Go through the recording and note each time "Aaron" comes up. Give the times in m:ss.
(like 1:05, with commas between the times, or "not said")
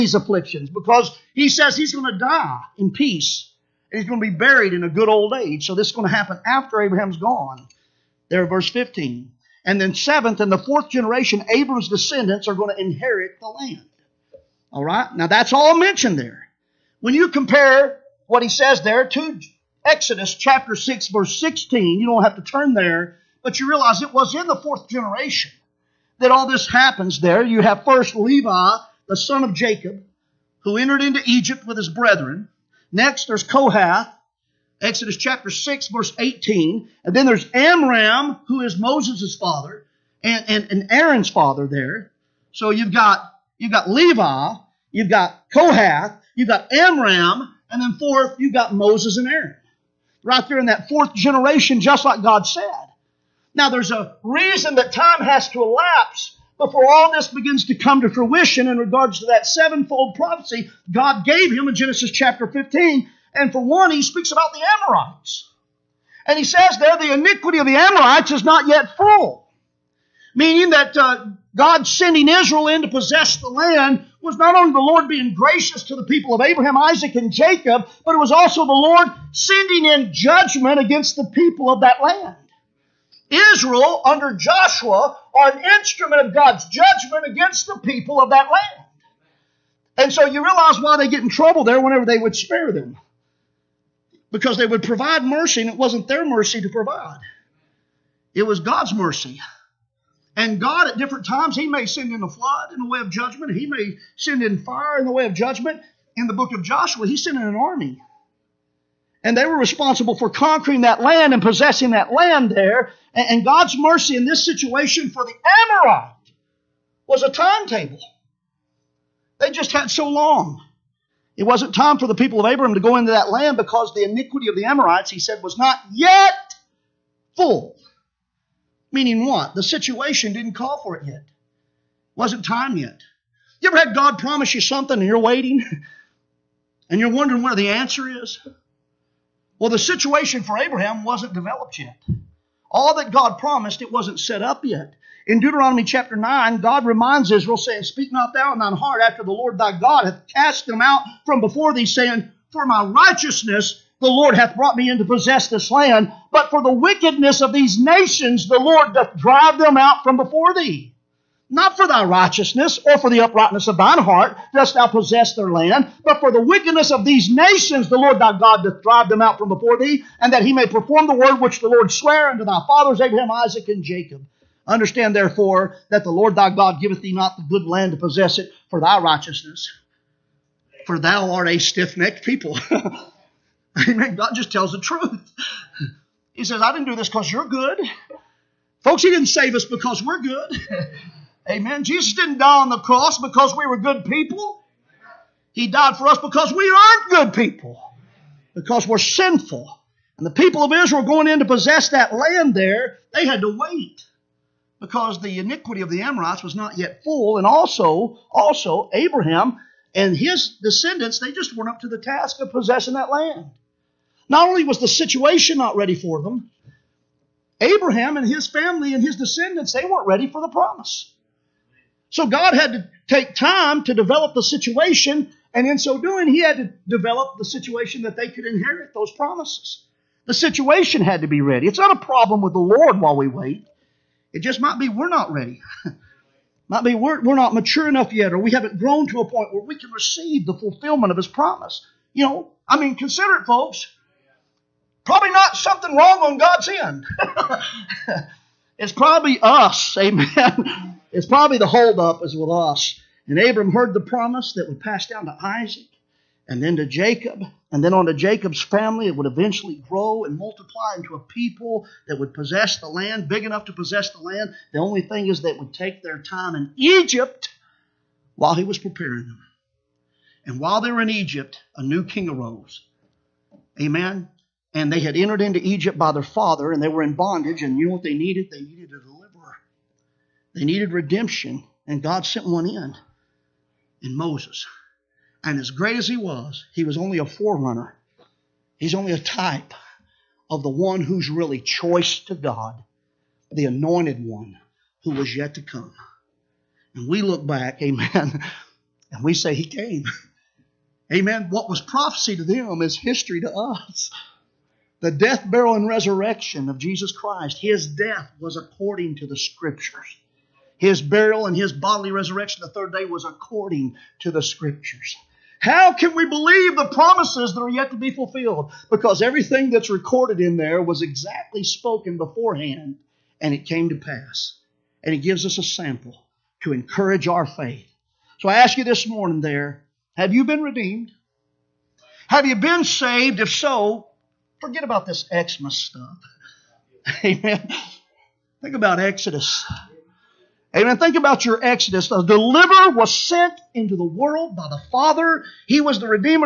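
0:40, 0:49.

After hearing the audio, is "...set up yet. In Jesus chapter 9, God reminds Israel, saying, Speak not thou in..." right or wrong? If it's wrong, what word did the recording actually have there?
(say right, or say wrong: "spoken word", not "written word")
wrong: "Deuteronomy", not "Jesus".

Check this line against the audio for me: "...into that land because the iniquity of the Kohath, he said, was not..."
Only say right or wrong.
wrong.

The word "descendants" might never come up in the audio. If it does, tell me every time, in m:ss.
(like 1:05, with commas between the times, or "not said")
0:11, 3:30, 3:39.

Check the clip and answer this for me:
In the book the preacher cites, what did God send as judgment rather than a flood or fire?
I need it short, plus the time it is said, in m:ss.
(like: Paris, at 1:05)
An army, at 1:47.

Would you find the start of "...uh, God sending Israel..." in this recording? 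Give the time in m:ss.
1:10.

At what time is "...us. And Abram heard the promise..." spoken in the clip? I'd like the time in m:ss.
4:12.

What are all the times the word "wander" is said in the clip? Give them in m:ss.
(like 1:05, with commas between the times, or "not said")
not said.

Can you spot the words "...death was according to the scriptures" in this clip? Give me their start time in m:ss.
5:07.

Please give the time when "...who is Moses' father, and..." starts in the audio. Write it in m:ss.
0:38.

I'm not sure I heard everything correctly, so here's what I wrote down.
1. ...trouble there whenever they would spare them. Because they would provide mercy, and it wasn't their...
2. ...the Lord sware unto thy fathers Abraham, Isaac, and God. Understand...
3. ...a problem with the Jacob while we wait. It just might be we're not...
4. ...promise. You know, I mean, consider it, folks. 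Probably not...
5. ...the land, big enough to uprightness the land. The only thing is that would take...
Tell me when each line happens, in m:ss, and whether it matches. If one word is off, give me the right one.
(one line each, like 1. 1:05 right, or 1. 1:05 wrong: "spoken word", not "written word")
1. 1:31 right
2. 2:51 wrong: "Jacob", not "God"
3. 3:51 wrong: "Lord", not "Jacob"
4. 4:01 right
5. 4:22 wrong: "possess", not "uprightness".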